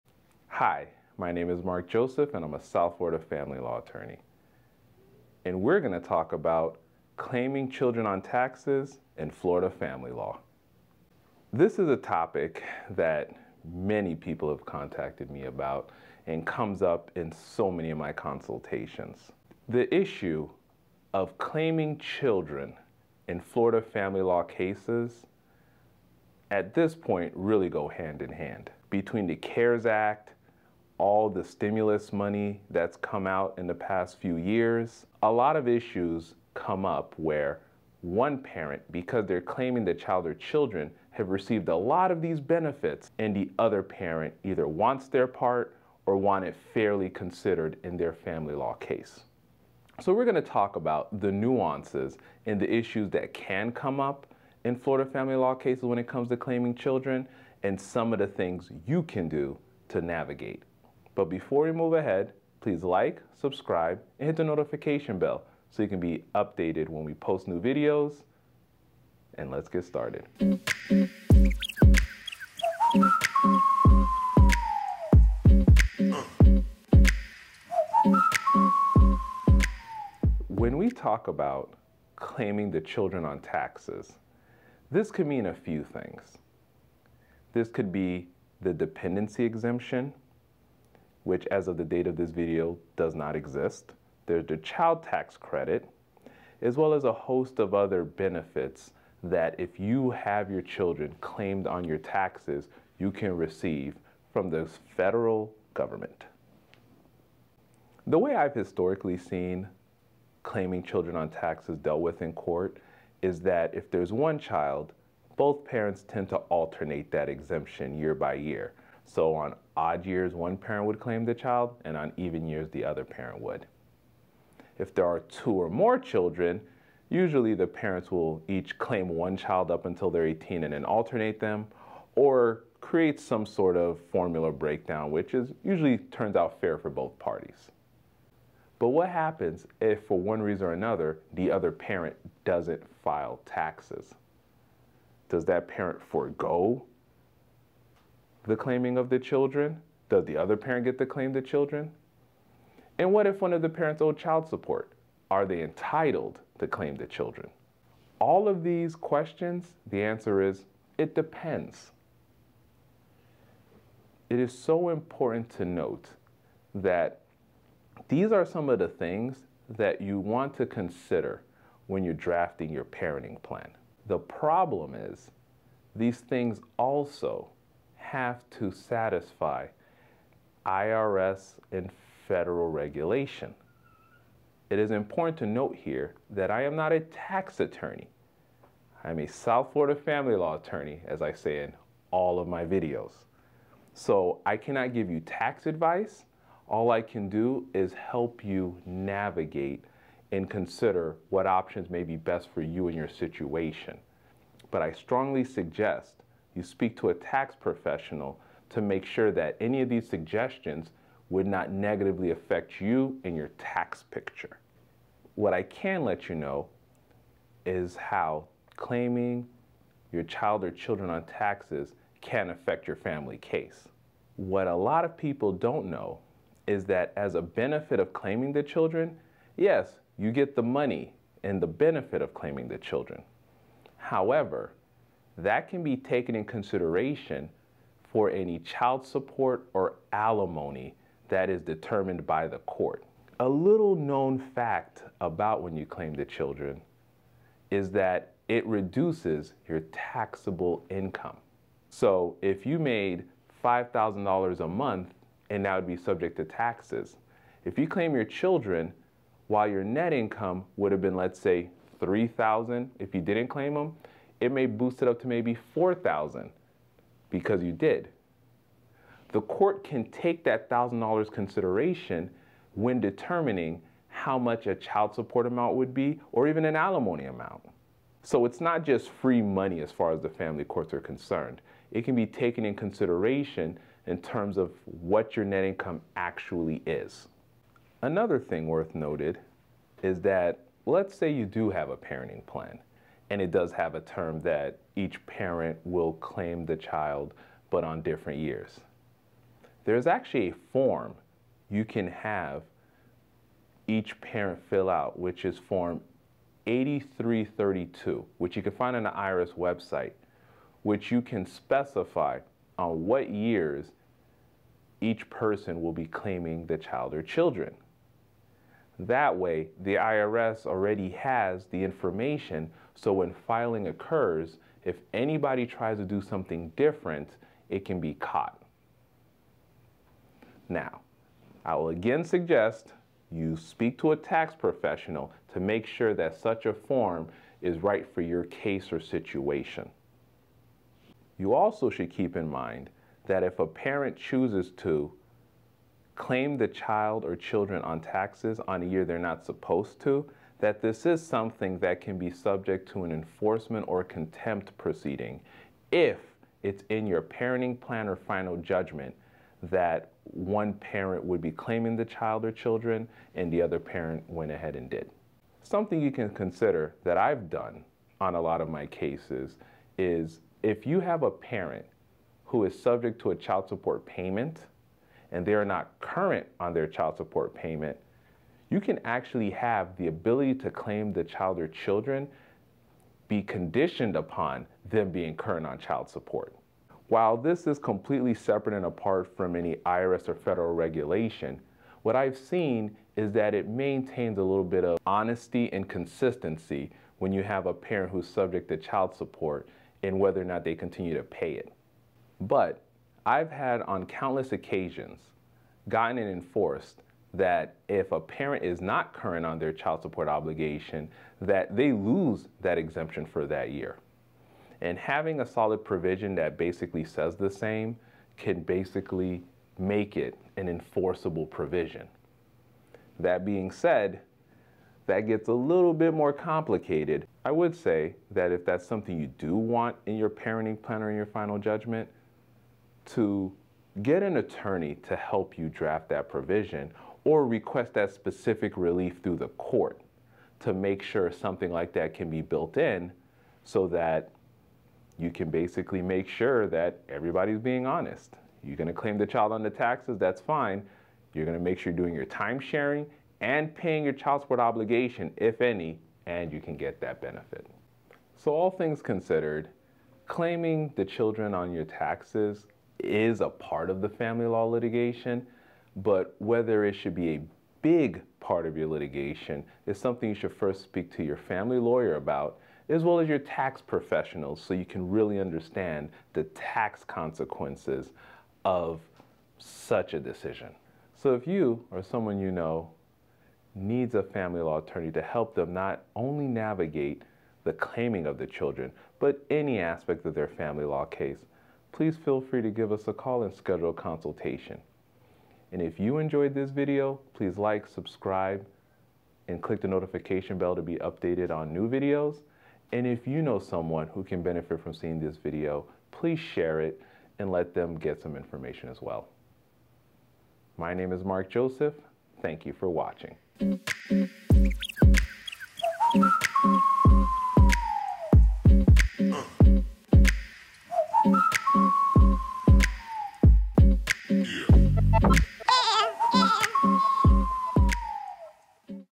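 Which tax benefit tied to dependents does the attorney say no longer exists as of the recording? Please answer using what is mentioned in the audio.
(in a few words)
dependency exemption.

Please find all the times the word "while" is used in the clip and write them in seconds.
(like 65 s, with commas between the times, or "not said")
259 s, 387 s.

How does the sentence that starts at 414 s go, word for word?
And having a solid provision that basically says the same can basically make it an enforceable provision.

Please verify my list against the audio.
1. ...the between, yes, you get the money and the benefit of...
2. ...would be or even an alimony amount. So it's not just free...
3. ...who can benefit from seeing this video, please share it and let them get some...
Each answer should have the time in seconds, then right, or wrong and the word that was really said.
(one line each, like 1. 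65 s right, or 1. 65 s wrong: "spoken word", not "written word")
1. 228 s wrong: "children", not "between"
2. 275 s right
3. 504 s right.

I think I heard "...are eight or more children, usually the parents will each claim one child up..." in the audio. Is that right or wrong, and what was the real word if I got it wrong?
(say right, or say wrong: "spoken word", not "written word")
wrong: "two", not "eight".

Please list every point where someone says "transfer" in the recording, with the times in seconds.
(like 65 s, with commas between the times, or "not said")
not said.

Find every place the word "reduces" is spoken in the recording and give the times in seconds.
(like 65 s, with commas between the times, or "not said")
248 s.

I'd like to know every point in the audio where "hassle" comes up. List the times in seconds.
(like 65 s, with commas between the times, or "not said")
not said.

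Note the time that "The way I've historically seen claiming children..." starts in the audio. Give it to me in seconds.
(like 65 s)
108 s.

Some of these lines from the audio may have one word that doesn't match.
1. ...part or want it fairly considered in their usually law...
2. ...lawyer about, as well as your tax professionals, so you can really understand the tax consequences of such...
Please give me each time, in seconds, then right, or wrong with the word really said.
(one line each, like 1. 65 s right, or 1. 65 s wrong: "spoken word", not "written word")
1. 45 s wrong: "family", not "usually"
2. 471 s right.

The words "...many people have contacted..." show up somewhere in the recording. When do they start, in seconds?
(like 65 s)
13 s.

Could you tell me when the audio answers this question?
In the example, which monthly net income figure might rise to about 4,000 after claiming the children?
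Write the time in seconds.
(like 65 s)
261 s.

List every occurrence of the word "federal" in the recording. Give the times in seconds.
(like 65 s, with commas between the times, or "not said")
104 s, 182 s, 390 s.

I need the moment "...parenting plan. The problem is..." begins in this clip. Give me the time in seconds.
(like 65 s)
172 s.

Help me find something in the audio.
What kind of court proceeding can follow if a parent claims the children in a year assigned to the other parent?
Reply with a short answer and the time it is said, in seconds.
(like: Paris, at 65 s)
enforcement or contempt, at 353 s.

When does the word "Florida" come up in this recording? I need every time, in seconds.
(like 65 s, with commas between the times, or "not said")
2 s, 9 s, 23 s, 54 s, 189 s.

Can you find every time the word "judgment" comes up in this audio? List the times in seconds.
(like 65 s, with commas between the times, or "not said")
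358 s, 431 s.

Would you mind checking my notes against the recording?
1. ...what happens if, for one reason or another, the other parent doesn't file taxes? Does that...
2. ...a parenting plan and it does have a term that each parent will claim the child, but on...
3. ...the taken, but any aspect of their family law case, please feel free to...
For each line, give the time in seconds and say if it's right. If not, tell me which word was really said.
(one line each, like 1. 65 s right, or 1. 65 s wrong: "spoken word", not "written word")
1. 138 s right
2. 291 s right
3. 488 s wrong: "children", not "taken".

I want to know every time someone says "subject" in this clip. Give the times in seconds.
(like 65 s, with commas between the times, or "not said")
255 s, 352 s, 372 s, 398 s.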